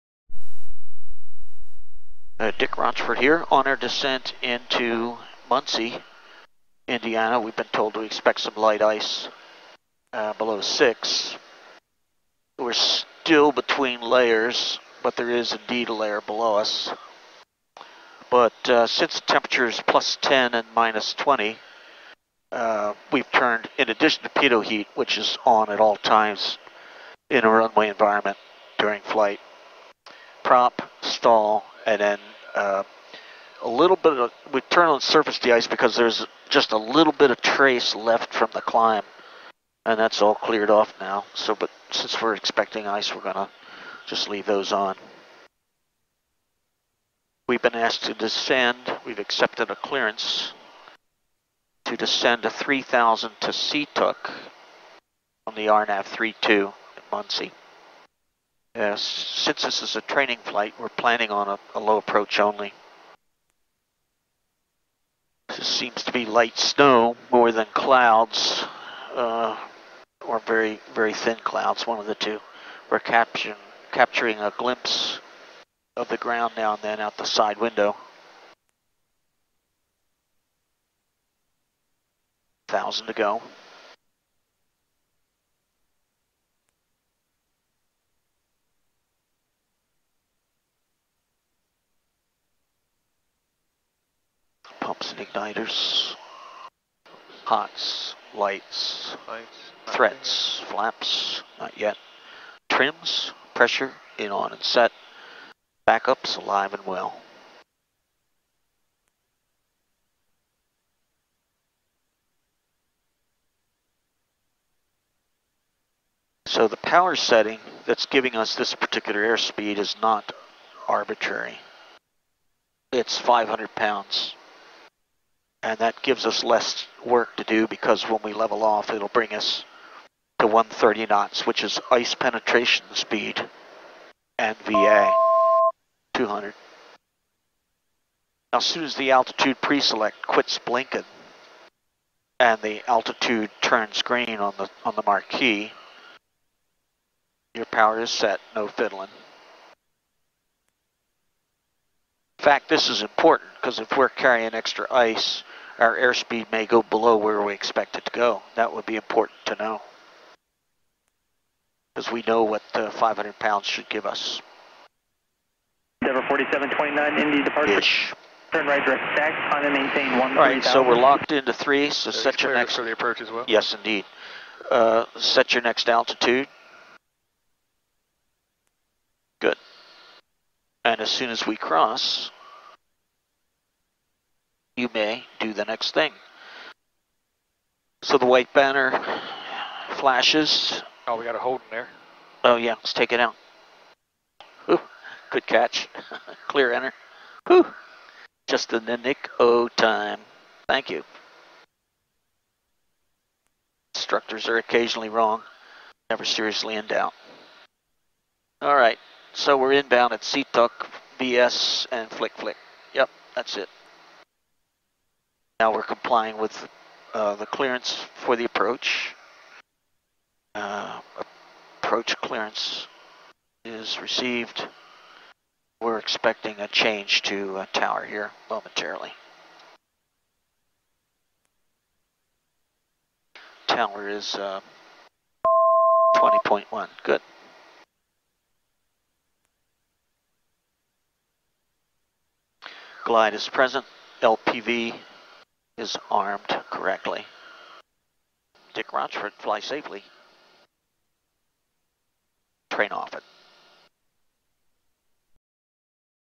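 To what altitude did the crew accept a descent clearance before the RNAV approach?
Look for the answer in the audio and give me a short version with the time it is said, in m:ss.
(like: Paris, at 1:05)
3,000, at 0:52.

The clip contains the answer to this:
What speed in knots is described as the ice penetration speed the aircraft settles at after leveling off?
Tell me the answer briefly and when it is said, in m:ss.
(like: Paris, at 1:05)
130 knots, at 2:10.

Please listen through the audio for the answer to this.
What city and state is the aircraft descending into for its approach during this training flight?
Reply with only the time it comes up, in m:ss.
0:05.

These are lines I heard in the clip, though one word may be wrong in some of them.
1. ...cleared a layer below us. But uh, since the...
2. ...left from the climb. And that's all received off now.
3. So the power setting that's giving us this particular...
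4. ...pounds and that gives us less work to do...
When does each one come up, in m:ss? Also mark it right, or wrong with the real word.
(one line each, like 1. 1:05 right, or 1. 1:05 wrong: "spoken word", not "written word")
1. 0:15 wrong: "indeed", not "cleared"
2. 0:37 wrong: "cleared", not "received"
3. 1:56 right
4. 2:03 right.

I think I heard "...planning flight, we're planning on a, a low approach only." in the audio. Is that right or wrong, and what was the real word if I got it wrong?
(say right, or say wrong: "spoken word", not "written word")
wrong: "training", not "planning".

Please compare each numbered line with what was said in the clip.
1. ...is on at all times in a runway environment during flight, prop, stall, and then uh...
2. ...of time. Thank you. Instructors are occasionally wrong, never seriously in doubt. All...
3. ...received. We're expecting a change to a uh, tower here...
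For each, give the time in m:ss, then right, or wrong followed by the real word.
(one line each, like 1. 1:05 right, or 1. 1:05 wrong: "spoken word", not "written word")
1. 0:25 right
2. 3:19 right
3. 3:44 right.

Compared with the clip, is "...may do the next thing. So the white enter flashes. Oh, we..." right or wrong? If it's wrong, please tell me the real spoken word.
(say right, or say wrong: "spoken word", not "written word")
wrong: "banner", not "enter".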